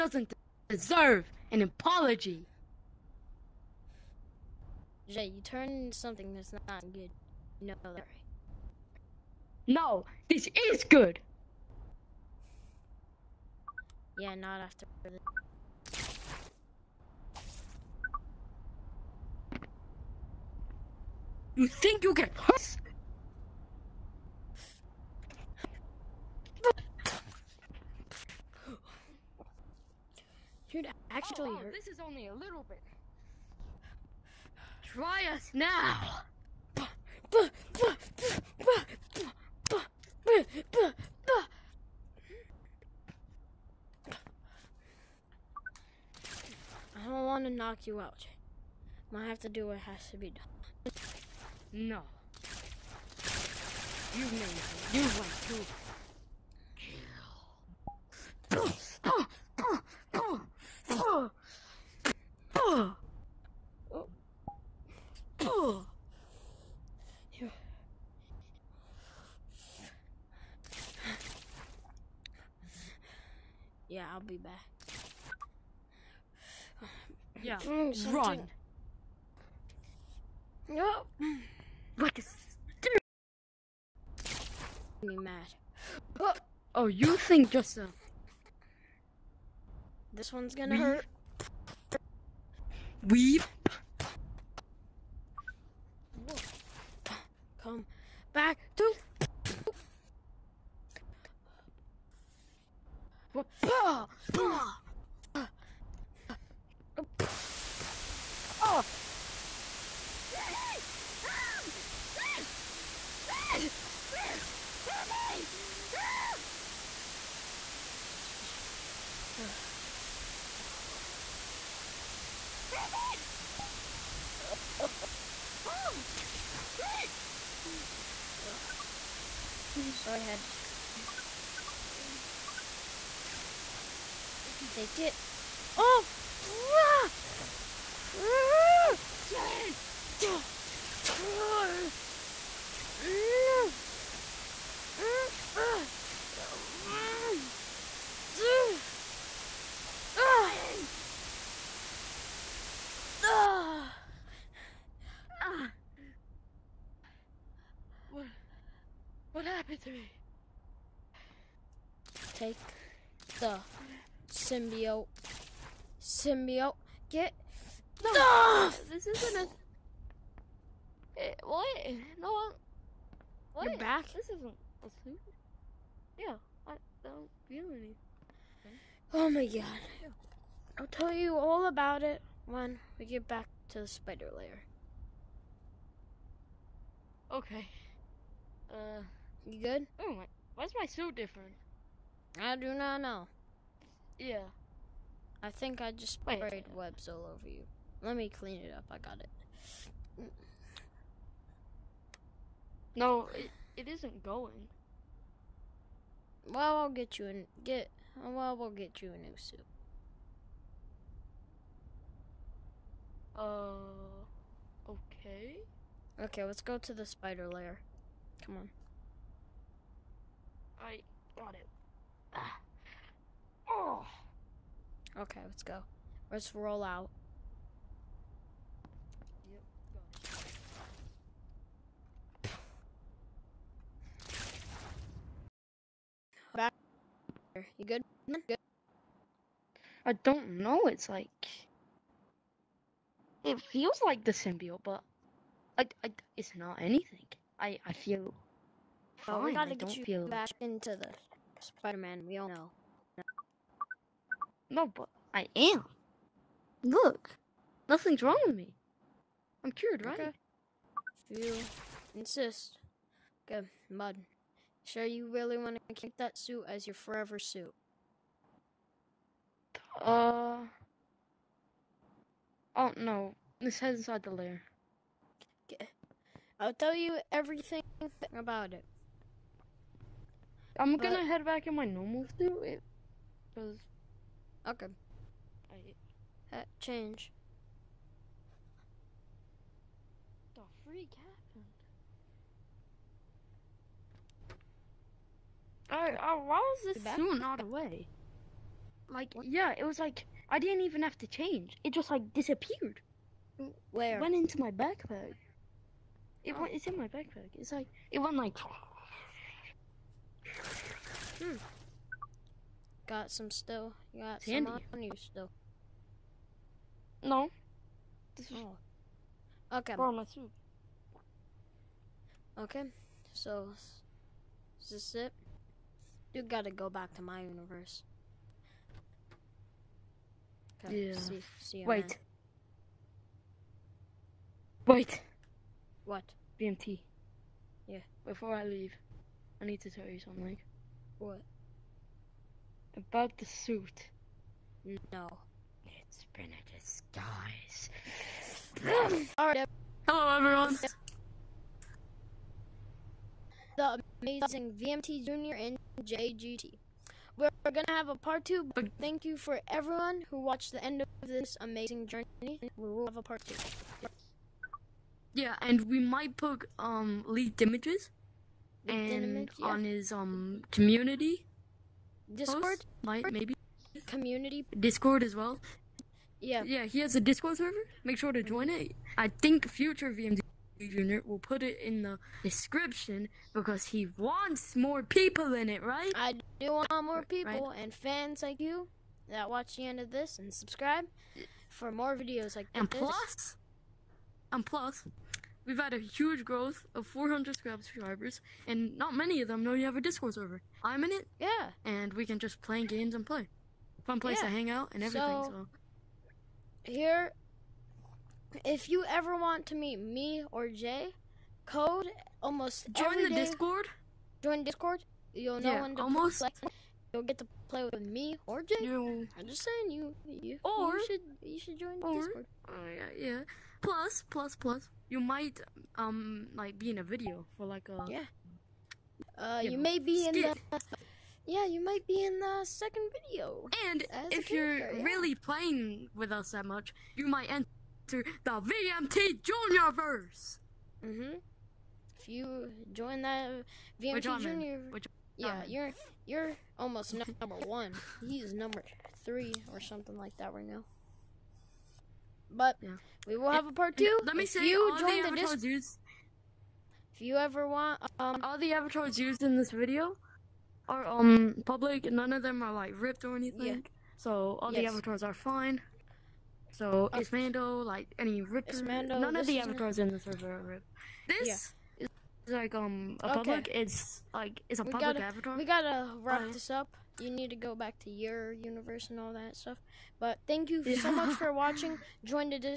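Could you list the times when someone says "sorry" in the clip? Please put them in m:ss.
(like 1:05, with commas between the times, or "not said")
0:07, 2:09.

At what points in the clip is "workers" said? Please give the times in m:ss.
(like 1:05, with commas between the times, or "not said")
not said.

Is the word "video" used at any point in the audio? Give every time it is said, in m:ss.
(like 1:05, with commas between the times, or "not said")
6:32, 7:07, 7:13, 7:39.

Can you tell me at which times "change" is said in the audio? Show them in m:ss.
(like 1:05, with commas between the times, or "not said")
4:46, 5:01.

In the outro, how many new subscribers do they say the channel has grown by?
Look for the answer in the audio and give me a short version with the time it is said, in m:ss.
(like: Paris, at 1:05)
400, at 6:37.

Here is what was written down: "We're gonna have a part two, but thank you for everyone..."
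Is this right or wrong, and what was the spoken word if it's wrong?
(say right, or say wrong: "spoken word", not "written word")
right.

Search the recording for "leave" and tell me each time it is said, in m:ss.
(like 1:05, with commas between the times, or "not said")
5:38.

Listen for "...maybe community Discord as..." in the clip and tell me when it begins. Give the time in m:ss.
6:13.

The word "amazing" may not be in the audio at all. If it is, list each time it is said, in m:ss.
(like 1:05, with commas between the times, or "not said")
5:54, 6:01.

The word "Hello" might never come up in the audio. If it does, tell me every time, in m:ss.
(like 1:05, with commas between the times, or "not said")
5:50.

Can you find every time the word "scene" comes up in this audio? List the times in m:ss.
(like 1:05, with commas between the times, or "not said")
not said.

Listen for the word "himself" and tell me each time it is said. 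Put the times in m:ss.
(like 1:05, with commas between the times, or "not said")
not said.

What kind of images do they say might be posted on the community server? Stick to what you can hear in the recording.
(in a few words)
leaked images.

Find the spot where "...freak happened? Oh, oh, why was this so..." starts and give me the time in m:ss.
4:50.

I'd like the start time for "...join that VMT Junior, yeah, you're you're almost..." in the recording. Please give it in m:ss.
7:22.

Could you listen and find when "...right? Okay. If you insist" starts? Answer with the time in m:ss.
4:20.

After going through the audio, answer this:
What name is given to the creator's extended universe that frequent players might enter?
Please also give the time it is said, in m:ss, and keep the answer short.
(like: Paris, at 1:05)
VMT Junior Juniorverse, at 7:18.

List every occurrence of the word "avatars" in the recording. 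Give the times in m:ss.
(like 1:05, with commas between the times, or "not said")
7:38, 7:44, 7:49, 7:55.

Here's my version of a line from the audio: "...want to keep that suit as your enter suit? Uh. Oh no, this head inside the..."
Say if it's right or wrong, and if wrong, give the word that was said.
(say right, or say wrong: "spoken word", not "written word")
wrong: "forever", not "enter".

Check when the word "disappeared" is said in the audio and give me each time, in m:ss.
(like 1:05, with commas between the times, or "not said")
5:02.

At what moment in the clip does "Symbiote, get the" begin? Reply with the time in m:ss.
2:46.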